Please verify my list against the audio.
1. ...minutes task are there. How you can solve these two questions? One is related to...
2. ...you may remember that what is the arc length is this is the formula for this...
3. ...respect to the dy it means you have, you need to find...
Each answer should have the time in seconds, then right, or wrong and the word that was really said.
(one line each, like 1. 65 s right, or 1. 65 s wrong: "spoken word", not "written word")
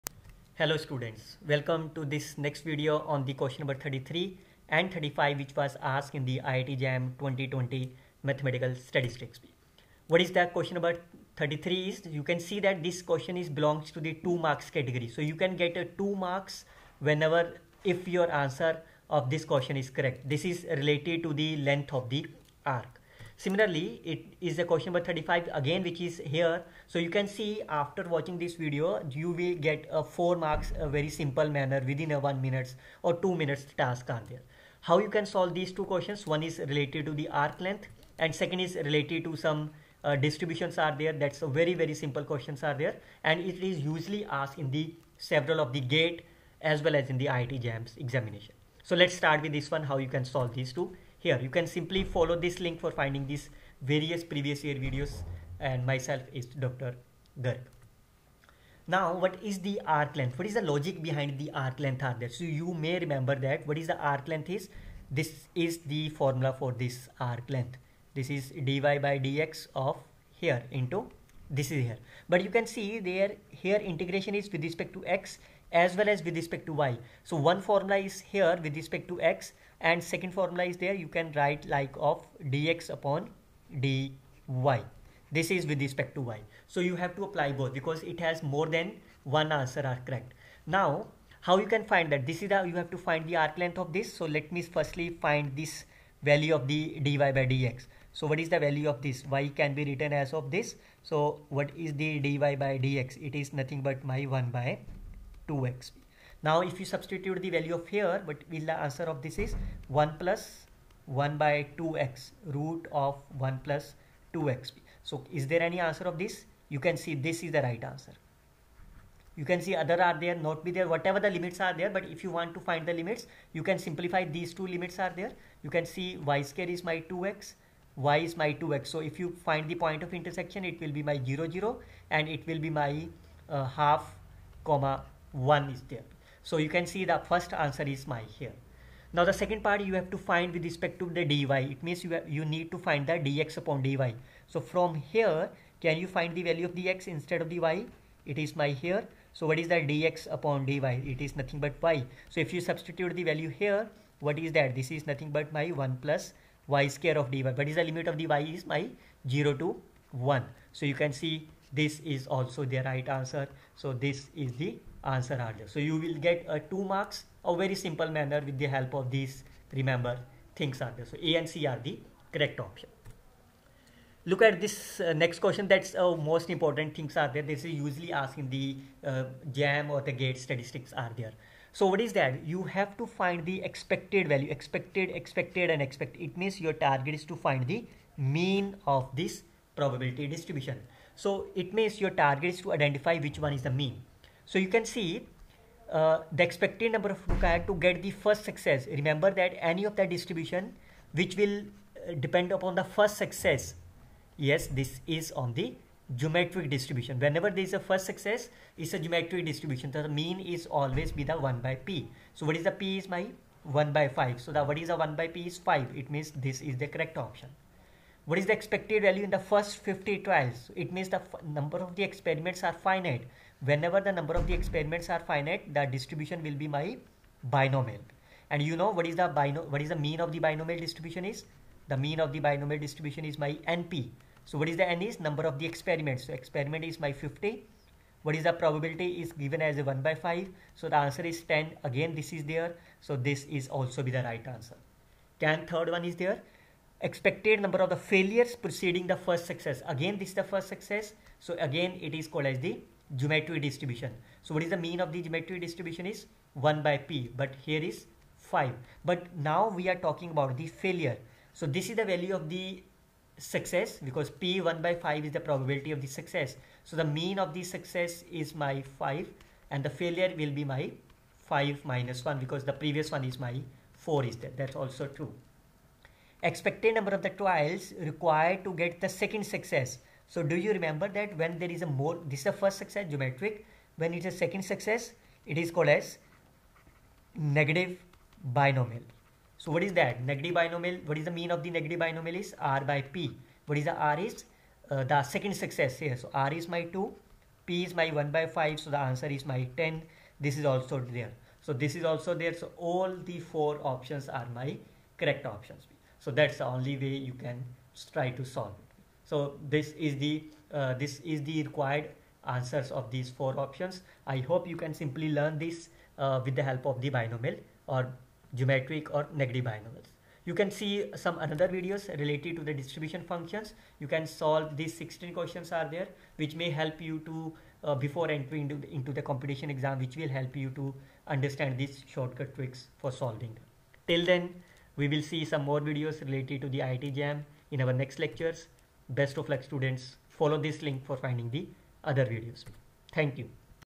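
1. 33 s right
2. 62 s right
3. 140 s right.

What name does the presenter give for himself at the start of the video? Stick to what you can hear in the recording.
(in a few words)
Dr. Garg.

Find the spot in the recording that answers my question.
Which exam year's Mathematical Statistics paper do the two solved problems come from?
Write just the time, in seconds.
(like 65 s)
7 s.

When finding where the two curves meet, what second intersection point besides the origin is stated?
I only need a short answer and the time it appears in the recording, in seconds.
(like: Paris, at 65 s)
(1/2, 1), at 133 s.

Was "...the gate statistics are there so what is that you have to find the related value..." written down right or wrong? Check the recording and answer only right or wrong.
wrong.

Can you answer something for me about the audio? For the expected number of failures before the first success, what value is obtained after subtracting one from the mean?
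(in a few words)
4.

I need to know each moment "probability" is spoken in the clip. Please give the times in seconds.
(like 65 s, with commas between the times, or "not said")
189 s, 238 s, 265 s.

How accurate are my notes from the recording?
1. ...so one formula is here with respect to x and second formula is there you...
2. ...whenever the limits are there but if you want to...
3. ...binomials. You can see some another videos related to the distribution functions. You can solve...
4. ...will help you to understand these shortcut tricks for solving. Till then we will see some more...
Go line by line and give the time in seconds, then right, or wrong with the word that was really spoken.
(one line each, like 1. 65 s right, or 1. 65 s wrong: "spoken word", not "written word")
1. 77 s right
2. 120 s wrong: "whatever", not "whenever"
3. 319 s right
4. 330 s right.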